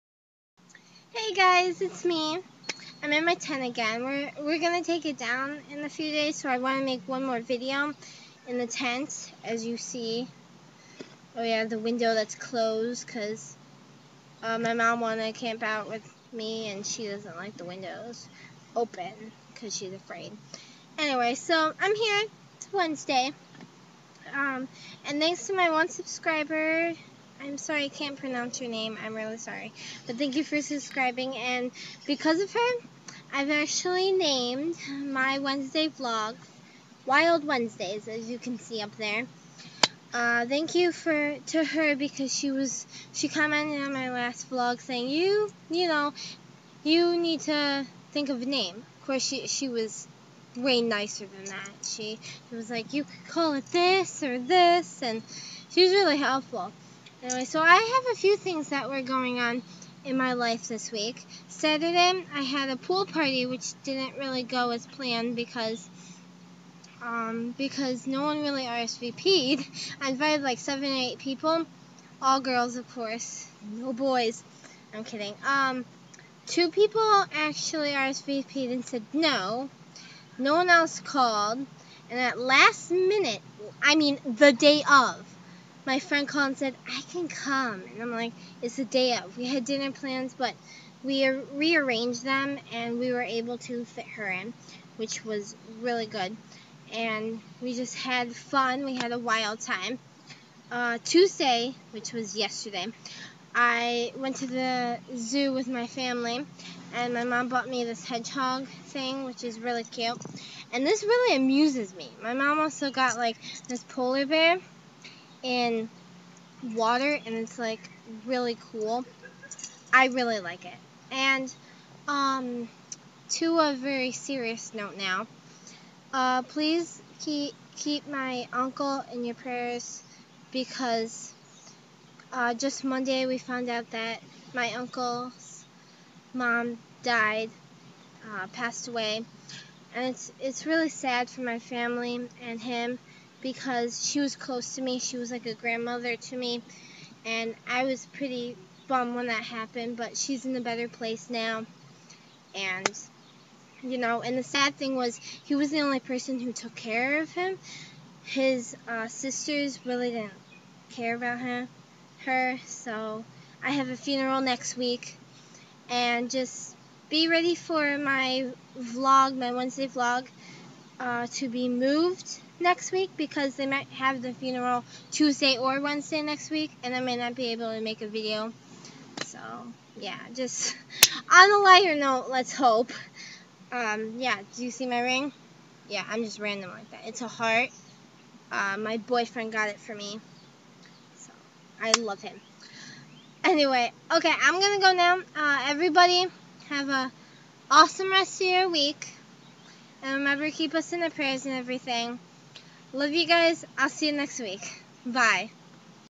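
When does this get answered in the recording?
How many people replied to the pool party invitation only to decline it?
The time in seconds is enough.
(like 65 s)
76 s.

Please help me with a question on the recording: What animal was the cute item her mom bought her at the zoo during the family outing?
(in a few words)
hedgehog.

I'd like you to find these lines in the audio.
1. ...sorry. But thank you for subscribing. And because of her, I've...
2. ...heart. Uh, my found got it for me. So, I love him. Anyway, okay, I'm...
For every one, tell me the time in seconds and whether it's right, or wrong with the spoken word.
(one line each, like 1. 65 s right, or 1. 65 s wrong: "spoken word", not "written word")
1. 29 s right
2. 187 s wrong: "boyfriend", not "found".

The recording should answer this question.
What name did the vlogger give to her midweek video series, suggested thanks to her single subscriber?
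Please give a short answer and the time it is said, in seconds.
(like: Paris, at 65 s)
Wild Wednesdays, at 37 s.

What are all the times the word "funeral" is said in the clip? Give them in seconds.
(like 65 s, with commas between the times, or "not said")
163 s, 174 s.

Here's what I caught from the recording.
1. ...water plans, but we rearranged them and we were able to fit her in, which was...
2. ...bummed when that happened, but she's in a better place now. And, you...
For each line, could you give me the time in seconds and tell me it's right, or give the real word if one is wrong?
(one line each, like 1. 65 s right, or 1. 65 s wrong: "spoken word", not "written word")
1. 89 s wrong: "dinner", not "water"
2. 148 s right.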